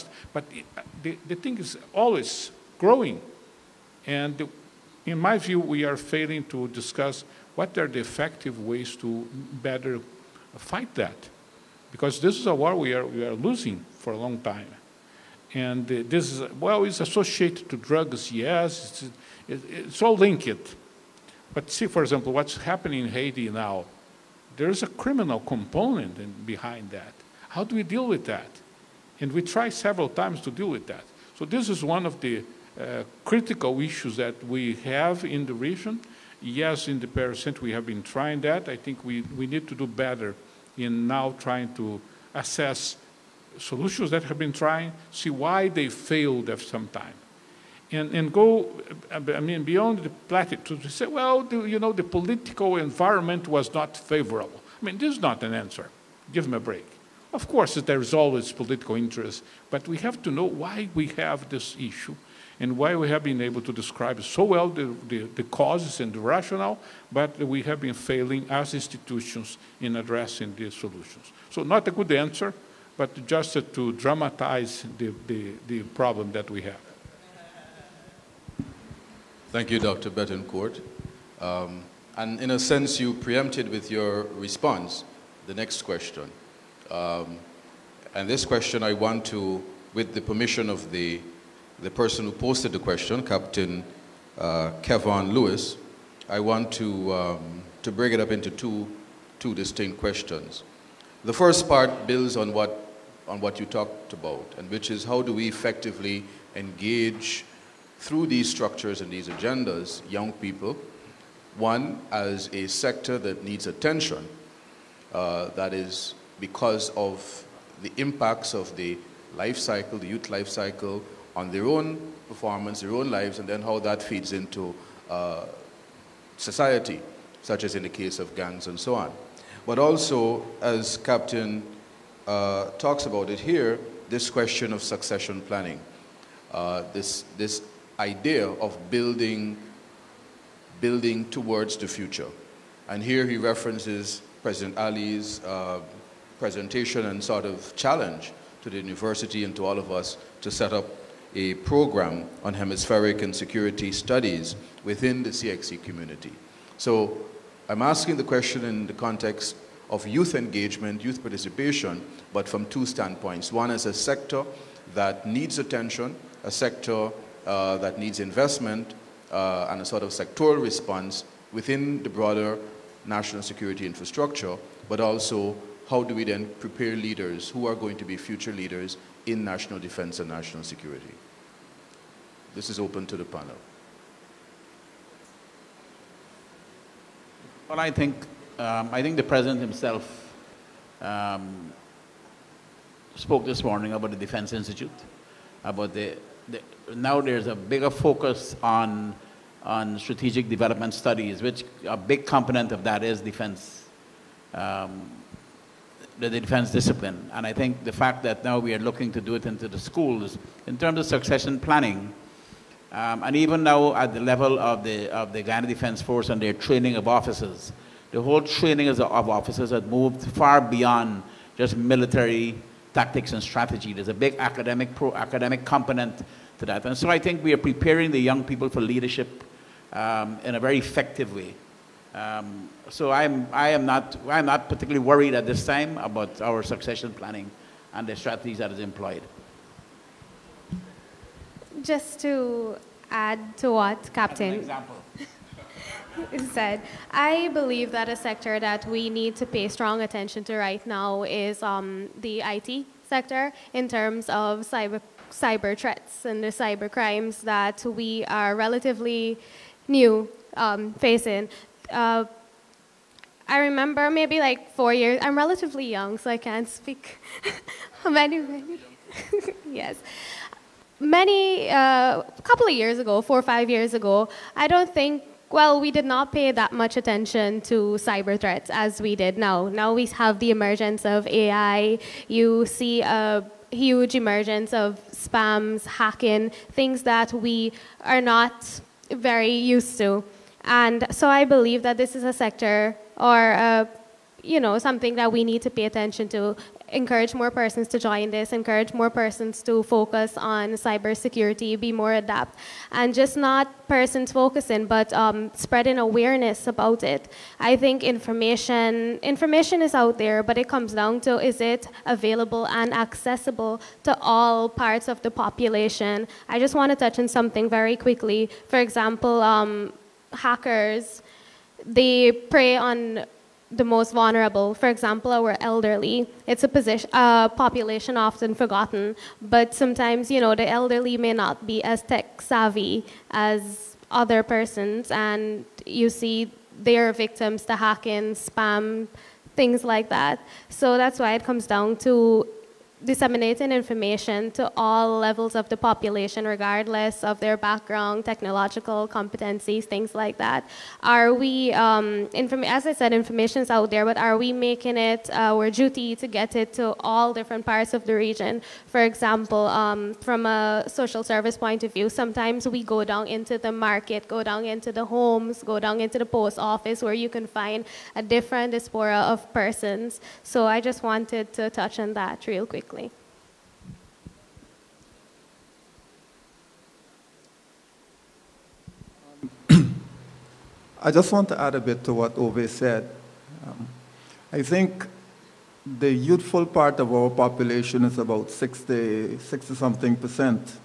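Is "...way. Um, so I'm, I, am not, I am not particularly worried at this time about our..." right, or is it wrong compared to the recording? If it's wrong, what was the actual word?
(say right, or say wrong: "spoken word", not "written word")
right.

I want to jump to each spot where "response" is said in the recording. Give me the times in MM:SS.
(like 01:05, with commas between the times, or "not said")
01:24, 02:50.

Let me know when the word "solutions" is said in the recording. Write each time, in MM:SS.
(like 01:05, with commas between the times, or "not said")
00:43, 01:10.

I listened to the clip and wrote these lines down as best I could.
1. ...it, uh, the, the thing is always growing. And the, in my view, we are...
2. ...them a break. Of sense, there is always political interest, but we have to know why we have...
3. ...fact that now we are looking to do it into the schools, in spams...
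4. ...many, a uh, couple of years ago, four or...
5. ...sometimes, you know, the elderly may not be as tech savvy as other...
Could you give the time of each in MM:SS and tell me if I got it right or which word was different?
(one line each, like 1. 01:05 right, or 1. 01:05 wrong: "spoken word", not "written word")
1. 00:00 right
2. 00:56 wrong: "course", not "sense"
3. 03:27 wrong: "terms", not "spams"
4. 04:30 right
5. 05:29 right.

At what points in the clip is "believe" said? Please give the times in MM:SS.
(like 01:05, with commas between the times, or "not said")
04:07, 04:51.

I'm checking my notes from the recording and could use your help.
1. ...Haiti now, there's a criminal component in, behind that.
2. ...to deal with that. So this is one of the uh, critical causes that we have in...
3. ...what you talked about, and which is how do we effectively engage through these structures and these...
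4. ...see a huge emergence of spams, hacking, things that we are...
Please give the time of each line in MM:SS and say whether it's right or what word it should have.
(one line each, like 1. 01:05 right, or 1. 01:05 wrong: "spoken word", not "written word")
1. 00:23 right
2. 00:30 wrong: "issues", not "causes"
3. 01:43 right
4. 04:42 right.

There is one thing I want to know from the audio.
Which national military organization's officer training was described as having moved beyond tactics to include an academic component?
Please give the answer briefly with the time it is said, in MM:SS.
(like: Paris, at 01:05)
Guyana Defense Force, at 03:35.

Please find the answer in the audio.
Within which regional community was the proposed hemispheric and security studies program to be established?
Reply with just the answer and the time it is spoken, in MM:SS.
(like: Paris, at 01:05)
CXC, at 02:35.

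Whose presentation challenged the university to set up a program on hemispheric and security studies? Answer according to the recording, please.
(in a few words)
President Ali.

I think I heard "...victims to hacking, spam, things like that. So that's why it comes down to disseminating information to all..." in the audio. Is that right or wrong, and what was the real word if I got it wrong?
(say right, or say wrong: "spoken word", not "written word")
right.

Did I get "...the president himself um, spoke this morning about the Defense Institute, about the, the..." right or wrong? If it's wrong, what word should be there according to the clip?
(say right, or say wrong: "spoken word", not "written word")
right.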